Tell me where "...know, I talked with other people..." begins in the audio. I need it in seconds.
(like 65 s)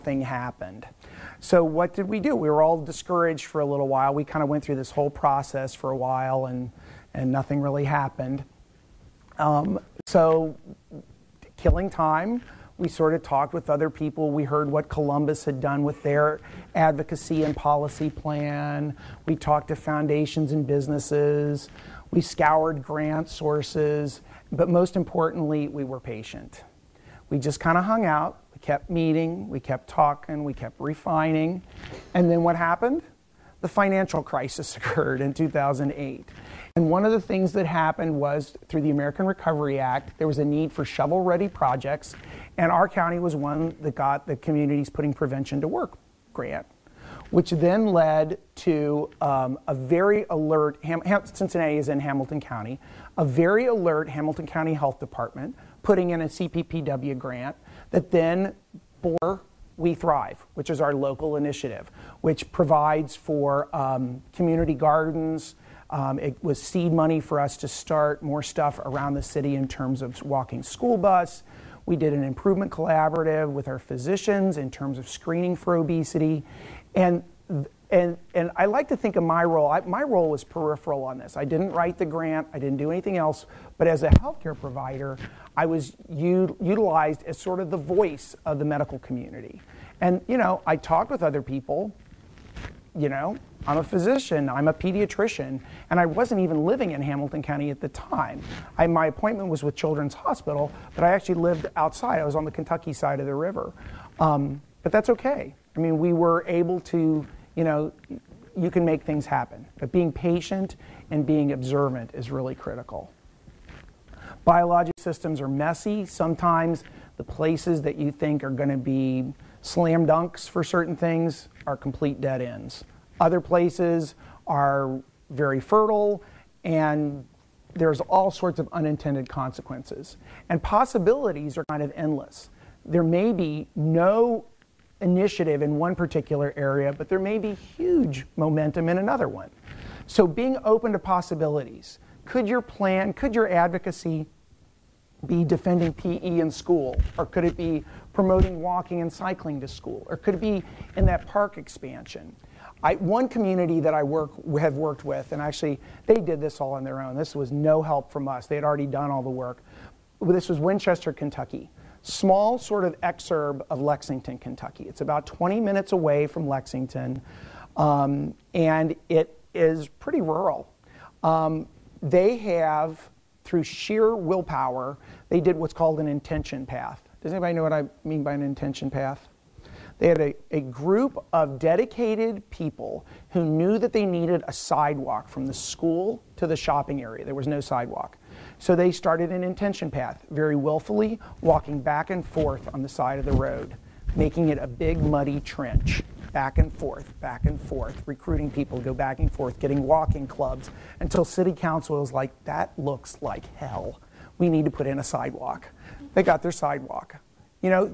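90 s.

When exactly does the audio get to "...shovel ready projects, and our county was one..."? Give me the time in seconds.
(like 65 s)
40 s.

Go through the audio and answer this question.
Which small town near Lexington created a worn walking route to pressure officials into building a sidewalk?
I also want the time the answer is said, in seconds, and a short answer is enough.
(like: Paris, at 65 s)
Winchester, Kentucky, at 160 s.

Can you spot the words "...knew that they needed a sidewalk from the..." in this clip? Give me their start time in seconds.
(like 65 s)
183 s.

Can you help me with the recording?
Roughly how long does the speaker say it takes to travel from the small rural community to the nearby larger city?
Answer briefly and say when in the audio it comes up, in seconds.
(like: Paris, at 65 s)
20 minutes, at 165 s.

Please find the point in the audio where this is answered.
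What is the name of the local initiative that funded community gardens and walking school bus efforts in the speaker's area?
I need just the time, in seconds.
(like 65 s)
59 s.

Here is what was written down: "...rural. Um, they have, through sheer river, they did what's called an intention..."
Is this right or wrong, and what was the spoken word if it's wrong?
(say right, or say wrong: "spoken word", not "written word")
wrong: "willpower", not "river".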